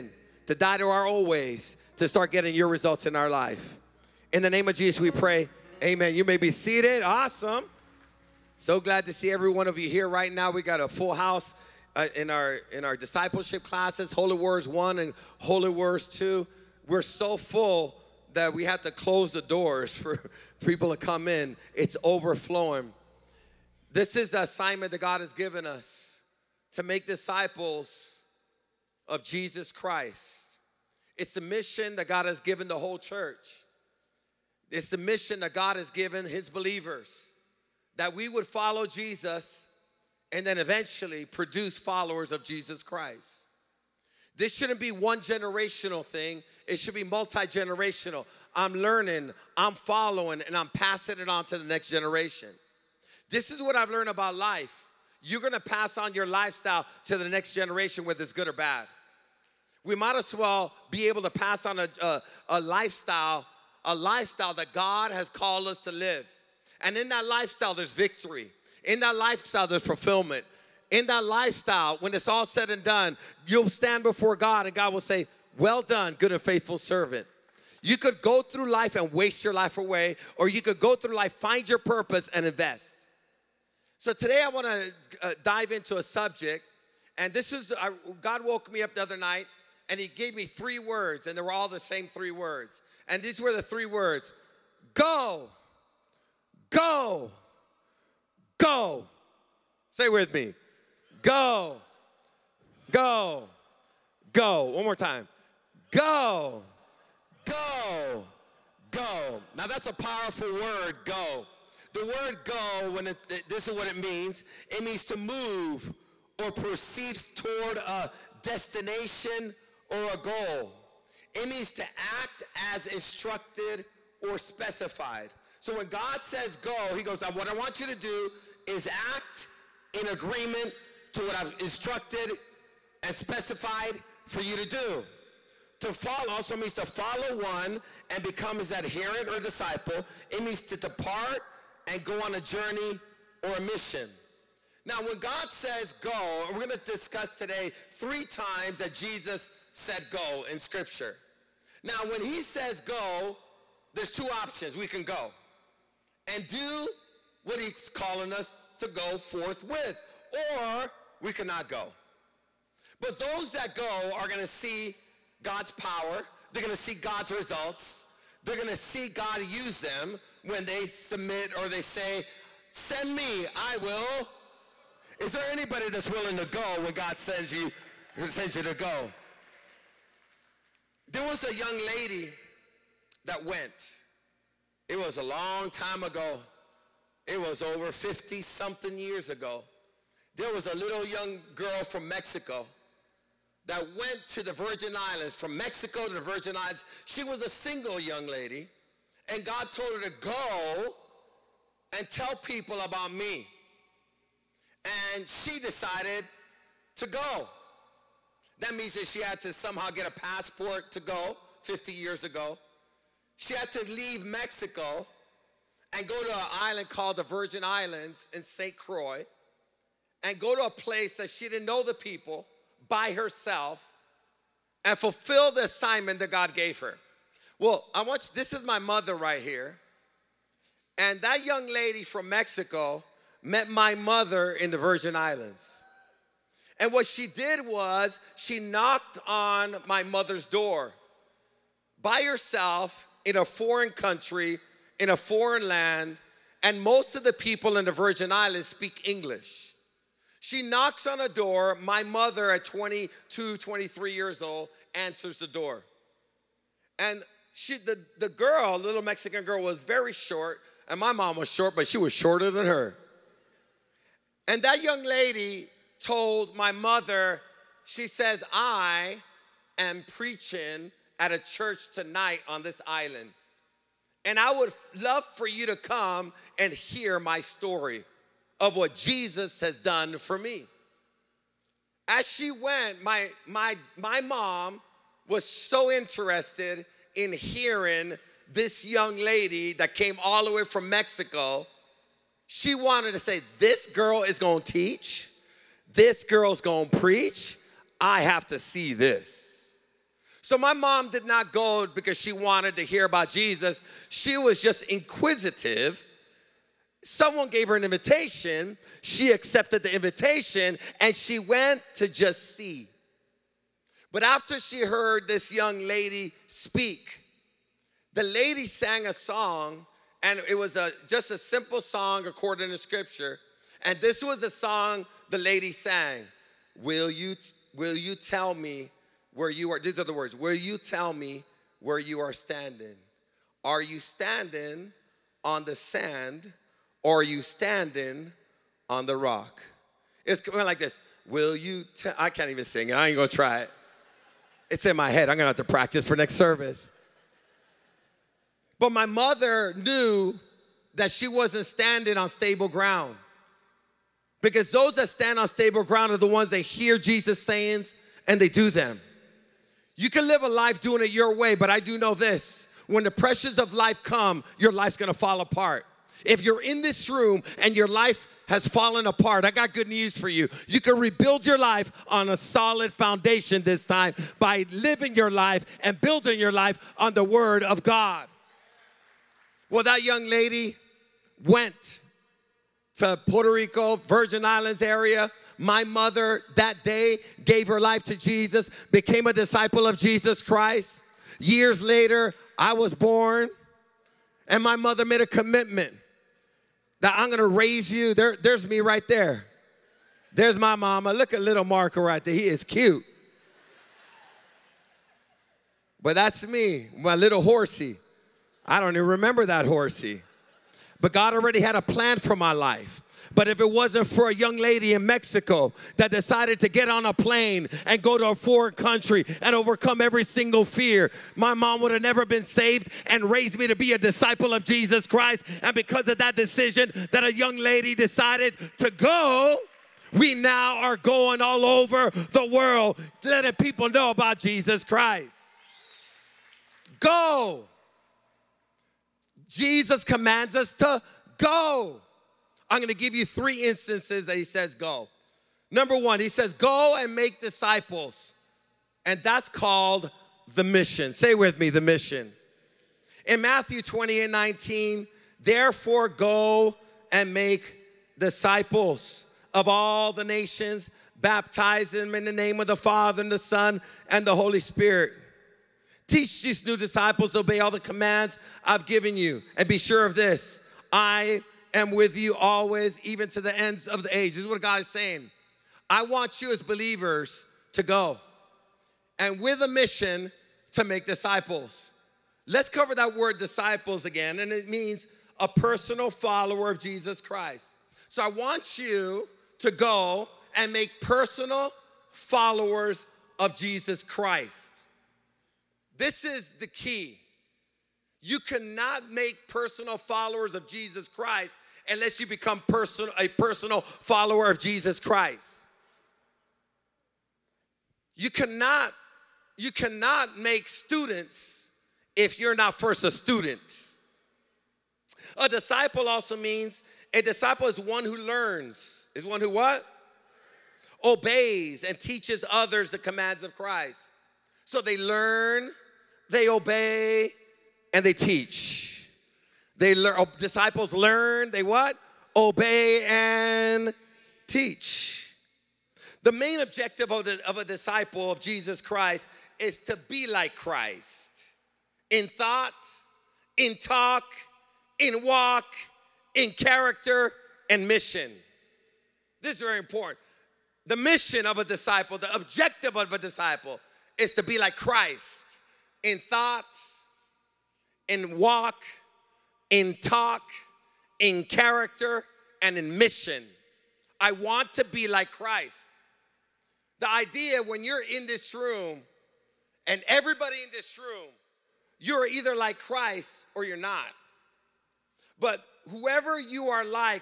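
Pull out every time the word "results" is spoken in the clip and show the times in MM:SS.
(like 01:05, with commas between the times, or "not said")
00:02, 02:47.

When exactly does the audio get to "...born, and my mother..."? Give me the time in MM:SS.
06:32.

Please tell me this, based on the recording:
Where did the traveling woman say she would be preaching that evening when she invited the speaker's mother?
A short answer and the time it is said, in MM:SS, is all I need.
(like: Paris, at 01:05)
At a church, at 04:31.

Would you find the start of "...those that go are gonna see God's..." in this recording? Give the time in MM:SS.
02:43.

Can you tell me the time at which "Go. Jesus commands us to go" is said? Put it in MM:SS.
07:16.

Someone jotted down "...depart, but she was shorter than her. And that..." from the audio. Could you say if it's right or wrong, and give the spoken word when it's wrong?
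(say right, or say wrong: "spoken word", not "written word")
wrong: "short", not "depart".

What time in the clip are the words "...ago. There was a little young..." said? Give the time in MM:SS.
03:09.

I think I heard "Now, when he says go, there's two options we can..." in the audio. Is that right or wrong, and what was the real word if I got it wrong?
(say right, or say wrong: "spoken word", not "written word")
right.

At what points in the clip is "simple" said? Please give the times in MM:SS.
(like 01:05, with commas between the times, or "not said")
05:21.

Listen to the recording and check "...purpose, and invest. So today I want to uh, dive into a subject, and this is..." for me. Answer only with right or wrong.
right.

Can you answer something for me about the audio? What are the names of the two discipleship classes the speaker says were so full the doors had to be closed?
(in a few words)
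Holy Words 1 and Holy Words 2.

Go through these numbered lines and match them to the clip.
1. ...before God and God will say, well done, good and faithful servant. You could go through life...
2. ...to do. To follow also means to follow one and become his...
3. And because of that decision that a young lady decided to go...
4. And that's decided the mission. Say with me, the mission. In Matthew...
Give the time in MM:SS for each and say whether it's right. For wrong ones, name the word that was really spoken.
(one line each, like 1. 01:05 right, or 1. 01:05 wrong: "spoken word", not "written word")
1. 01:14 right
2. 02:14 right
3. 07:05 right
4. 07:29 wrong: "called", not "decided".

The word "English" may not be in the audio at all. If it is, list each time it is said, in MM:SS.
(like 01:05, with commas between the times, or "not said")
04:09.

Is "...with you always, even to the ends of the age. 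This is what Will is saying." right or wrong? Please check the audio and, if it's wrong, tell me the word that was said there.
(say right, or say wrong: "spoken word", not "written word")
wrong: "God", not "Will".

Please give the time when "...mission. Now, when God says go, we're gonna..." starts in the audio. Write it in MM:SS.
02:23.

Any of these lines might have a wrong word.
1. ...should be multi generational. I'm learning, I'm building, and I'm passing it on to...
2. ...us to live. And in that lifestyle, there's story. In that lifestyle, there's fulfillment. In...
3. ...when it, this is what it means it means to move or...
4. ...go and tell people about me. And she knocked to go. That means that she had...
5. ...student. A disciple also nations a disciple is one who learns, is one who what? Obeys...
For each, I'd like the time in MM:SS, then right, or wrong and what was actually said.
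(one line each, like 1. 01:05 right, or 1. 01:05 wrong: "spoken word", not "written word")
1. 00:46 wrong: "following", not "building"
2. 01:05 wrong: "victory", not "story"
3. 01:52 right
4. 03:20 wrong: "decided", not "knocked"
5. 08:33 wrong: "means", not "nations".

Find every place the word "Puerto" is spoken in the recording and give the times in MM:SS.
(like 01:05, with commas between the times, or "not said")
06:23.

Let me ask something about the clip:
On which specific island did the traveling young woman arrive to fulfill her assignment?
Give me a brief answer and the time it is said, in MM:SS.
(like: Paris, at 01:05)
St. Croix, at 03:38.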